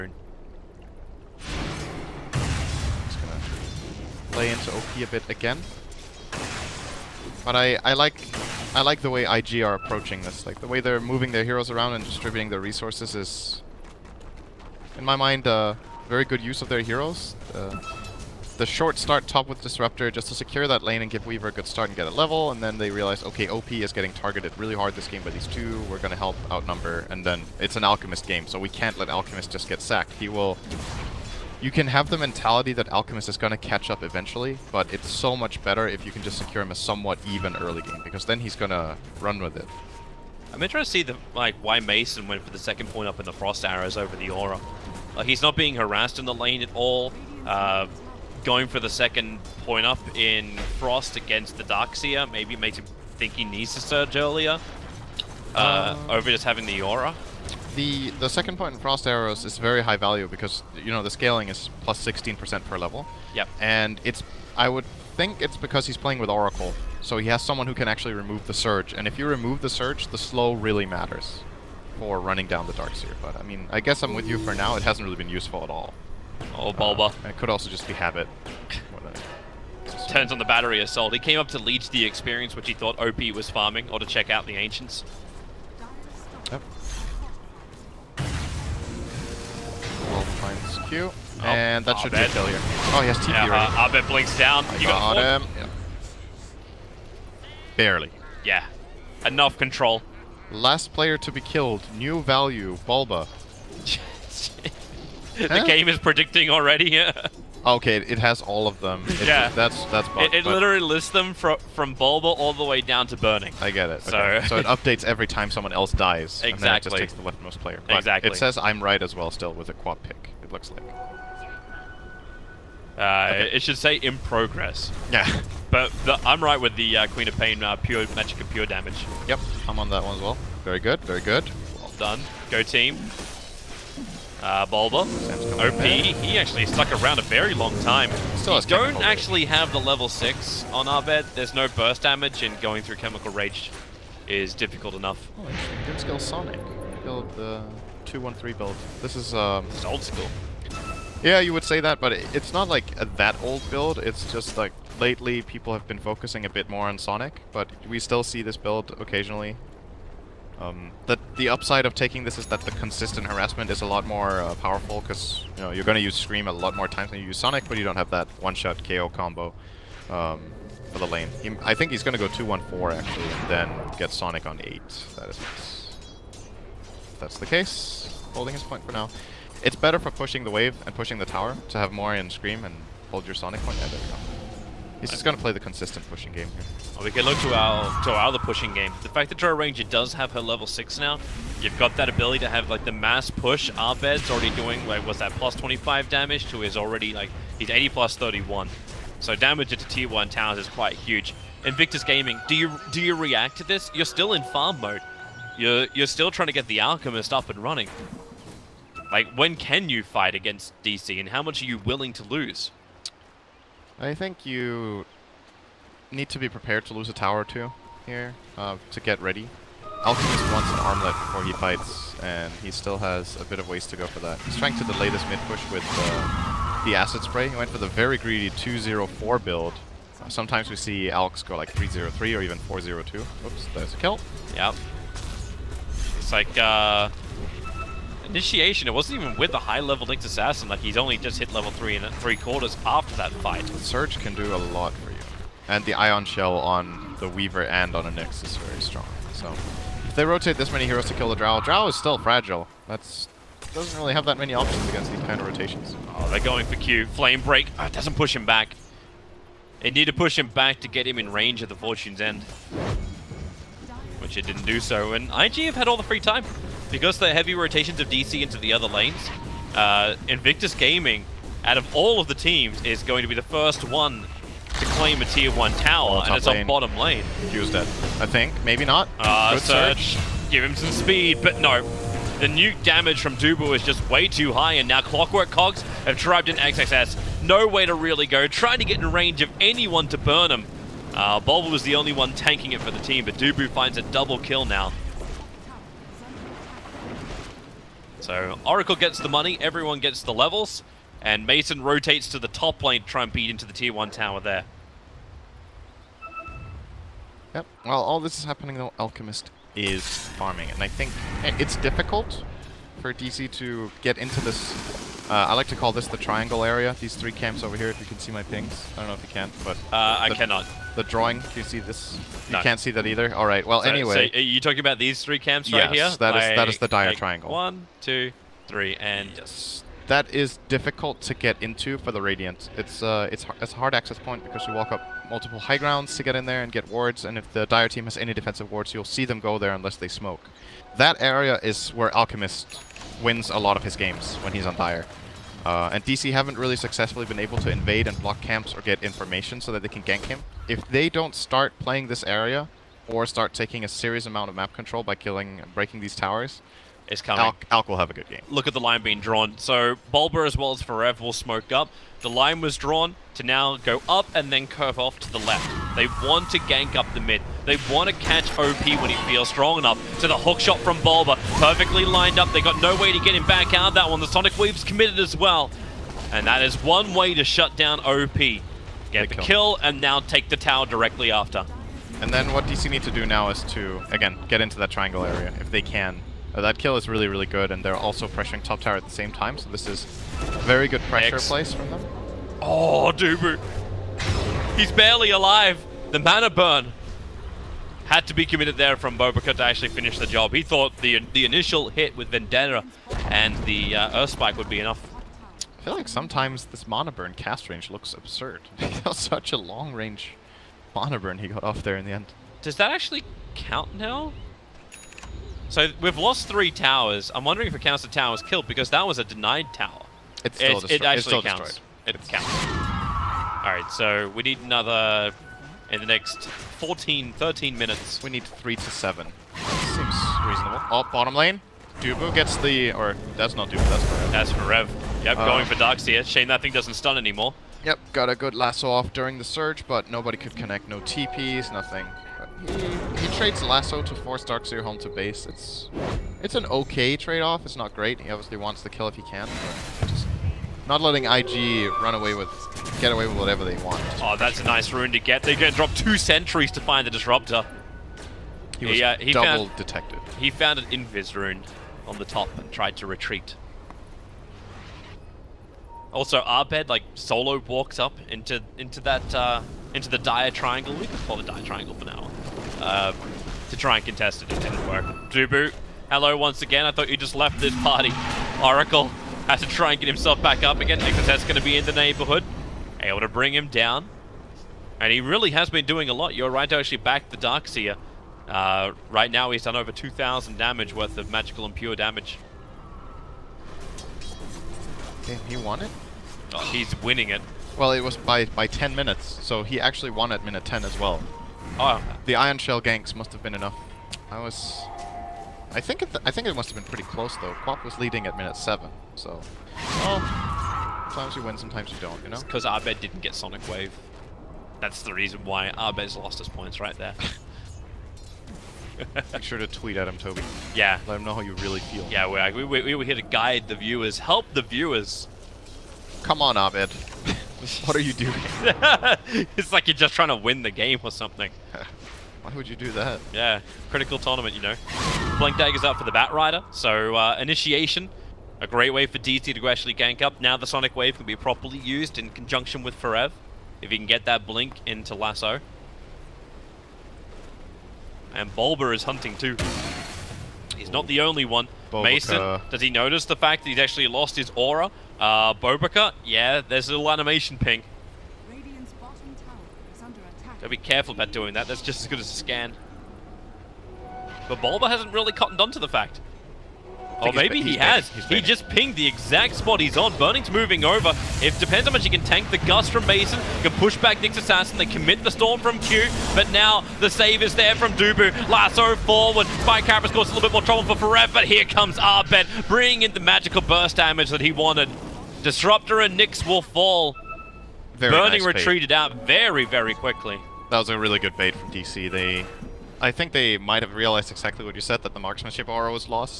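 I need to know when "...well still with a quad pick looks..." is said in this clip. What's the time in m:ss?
1:59.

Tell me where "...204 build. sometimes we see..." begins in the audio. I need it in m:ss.
3:48.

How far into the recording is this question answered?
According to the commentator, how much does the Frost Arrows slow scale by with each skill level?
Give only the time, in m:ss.
1:01.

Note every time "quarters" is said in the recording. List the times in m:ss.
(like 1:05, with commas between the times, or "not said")
4:02.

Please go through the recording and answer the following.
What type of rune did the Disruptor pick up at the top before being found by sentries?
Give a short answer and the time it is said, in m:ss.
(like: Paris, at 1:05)
Invis rune, at 7:40.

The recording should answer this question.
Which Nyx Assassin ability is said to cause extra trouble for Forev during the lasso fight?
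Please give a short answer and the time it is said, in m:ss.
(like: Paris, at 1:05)
Spike Carapace, at 9:39.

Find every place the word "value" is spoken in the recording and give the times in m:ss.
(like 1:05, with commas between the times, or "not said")
0:59, 1:42.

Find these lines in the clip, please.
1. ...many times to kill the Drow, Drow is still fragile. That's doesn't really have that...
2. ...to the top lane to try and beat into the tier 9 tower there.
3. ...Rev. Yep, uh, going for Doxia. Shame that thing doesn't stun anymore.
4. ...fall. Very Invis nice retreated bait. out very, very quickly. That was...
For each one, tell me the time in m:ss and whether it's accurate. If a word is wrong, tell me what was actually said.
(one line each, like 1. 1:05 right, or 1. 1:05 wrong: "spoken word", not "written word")
1. 4:10 wrong: "heroes", not "times"
2. 5:02 wrong: "1", not "9"
3. 7:14 right
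4. 9:46 wrong: "Burning", not "Invis".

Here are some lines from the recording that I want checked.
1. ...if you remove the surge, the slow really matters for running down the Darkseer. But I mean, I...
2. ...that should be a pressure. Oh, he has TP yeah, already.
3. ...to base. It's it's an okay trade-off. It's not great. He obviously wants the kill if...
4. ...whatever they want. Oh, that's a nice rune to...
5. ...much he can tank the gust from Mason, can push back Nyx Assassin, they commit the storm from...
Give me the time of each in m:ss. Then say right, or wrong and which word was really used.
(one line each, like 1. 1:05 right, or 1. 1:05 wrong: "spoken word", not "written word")
1. 1:09 right
2. 1:31 wrong: "failure", not "pressure"
3. 7:24 right
4. 7:33 right
5. 9:31 right.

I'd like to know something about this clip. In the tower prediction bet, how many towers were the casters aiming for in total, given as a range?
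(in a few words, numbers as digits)
3 to 7.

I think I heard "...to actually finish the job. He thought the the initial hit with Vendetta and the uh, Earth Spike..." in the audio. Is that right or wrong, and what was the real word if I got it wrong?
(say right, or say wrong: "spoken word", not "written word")
right.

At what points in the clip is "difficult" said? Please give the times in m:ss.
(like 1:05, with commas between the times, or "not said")
2:24, 5:11, 5:30.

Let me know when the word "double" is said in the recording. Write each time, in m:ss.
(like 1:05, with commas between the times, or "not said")
4:54, 7:39.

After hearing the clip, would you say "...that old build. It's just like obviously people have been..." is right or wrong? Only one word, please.
wrong.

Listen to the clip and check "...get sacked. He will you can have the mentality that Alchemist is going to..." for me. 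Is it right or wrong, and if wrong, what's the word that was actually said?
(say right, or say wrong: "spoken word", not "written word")
right.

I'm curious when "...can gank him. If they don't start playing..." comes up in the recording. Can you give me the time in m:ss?
5:49.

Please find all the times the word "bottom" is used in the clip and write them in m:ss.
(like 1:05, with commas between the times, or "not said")
4:36, 7:11.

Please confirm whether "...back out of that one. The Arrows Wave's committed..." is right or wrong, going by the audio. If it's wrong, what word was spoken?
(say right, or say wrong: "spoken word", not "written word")
wrong: "Sonic", not "Arrows".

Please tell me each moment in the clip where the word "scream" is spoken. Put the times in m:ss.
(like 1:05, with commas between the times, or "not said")
2:46, 3:02.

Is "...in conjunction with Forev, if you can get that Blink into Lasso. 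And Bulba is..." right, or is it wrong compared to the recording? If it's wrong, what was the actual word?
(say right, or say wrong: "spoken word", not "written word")
right.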